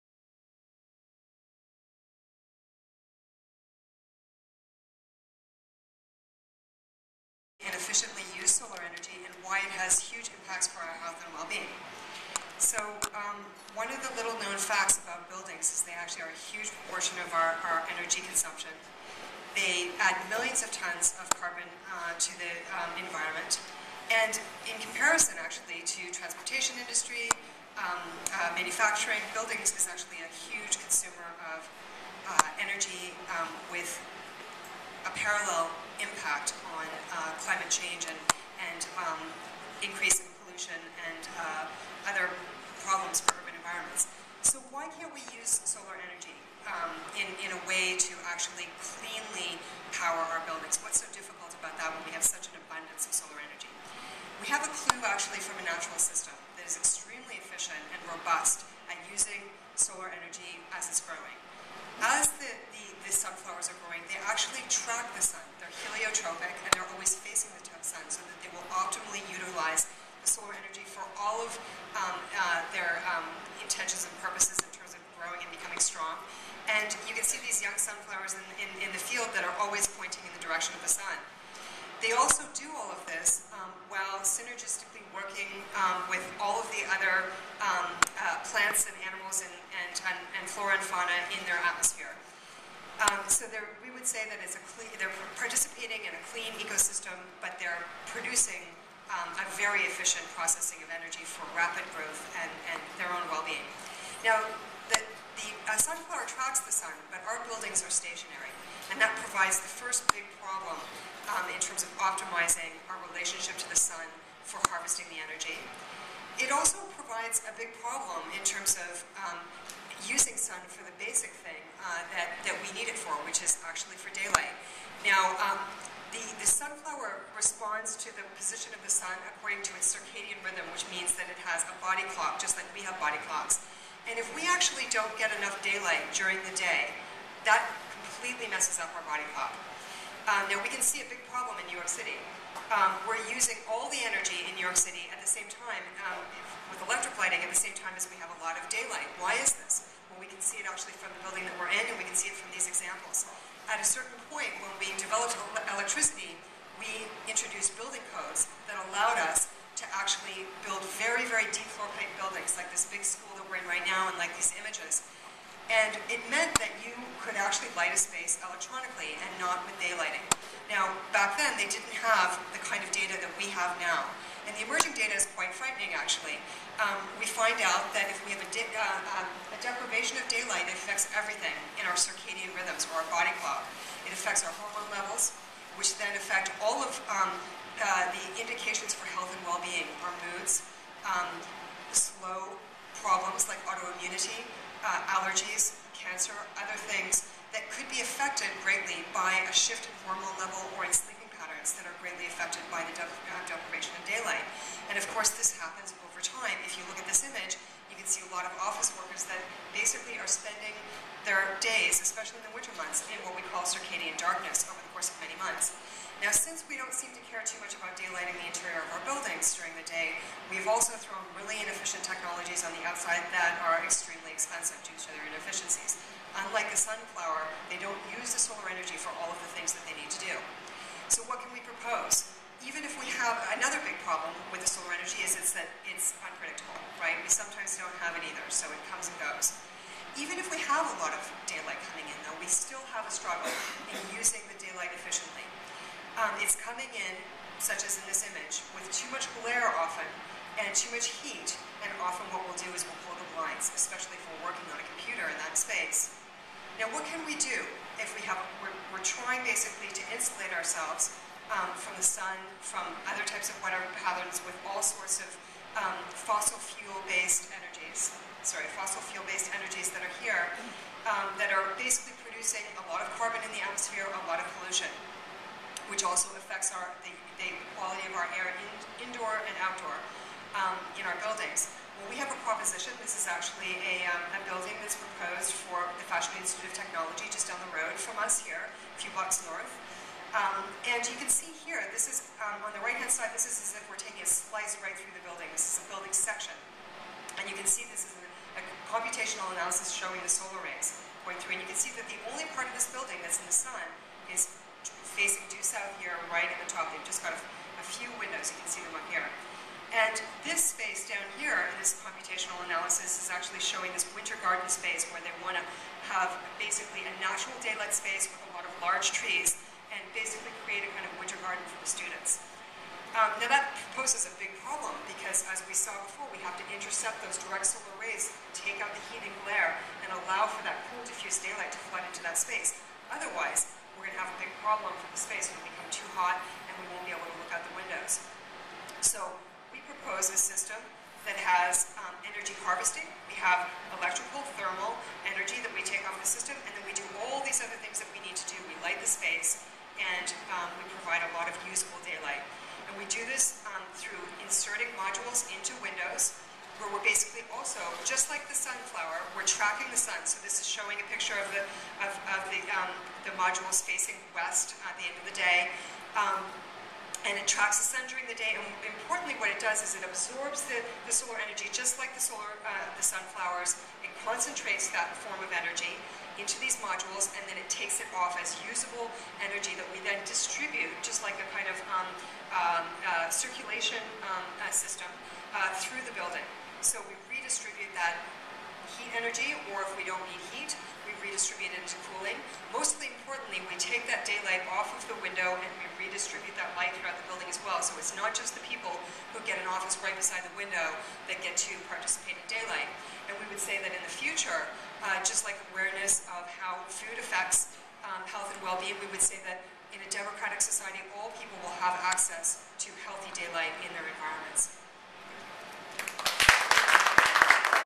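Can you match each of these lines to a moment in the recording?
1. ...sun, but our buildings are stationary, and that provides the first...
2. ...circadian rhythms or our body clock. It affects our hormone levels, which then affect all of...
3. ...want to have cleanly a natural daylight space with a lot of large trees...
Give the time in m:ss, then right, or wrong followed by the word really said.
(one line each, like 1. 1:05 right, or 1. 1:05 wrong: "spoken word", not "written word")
1. 1:46 right
2. 3:01 right
3. 5:15 wrong: "basically", not "cleanly".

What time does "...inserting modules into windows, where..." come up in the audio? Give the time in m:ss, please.
5:54.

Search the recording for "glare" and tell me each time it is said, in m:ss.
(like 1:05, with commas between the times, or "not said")
4:09, 5:29.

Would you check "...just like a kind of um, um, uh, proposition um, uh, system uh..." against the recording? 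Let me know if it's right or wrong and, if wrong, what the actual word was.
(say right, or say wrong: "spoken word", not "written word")
wrong: "circulation", not "proposition".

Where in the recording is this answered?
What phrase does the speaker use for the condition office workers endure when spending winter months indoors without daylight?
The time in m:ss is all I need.
3:33.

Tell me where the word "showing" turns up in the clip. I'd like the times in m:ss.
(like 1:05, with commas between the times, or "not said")
4:59, 5:13, 6:00.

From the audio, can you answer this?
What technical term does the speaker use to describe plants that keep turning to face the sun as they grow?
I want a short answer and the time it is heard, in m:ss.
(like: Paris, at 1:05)
Heliotropic, at 1:05.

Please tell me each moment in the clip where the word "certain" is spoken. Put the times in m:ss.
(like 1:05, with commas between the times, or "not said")
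2:33.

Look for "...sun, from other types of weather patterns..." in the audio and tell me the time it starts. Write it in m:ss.
4:22.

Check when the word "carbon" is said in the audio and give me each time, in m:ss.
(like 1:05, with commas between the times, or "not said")
0:21, 4:33.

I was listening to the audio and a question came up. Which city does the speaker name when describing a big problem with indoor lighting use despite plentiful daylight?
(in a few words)
New York City.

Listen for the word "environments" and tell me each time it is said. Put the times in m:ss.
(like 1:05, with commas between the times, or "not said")
0:22, 0:43, 6:54.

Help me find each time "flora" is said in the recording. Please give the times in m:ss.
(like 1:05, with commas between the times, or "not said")
1:30.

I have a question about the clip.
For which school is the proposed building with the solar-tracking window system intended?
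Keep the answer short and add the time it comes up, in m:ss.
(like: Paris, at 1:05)
Fashion Institute of Technology, at 4:46.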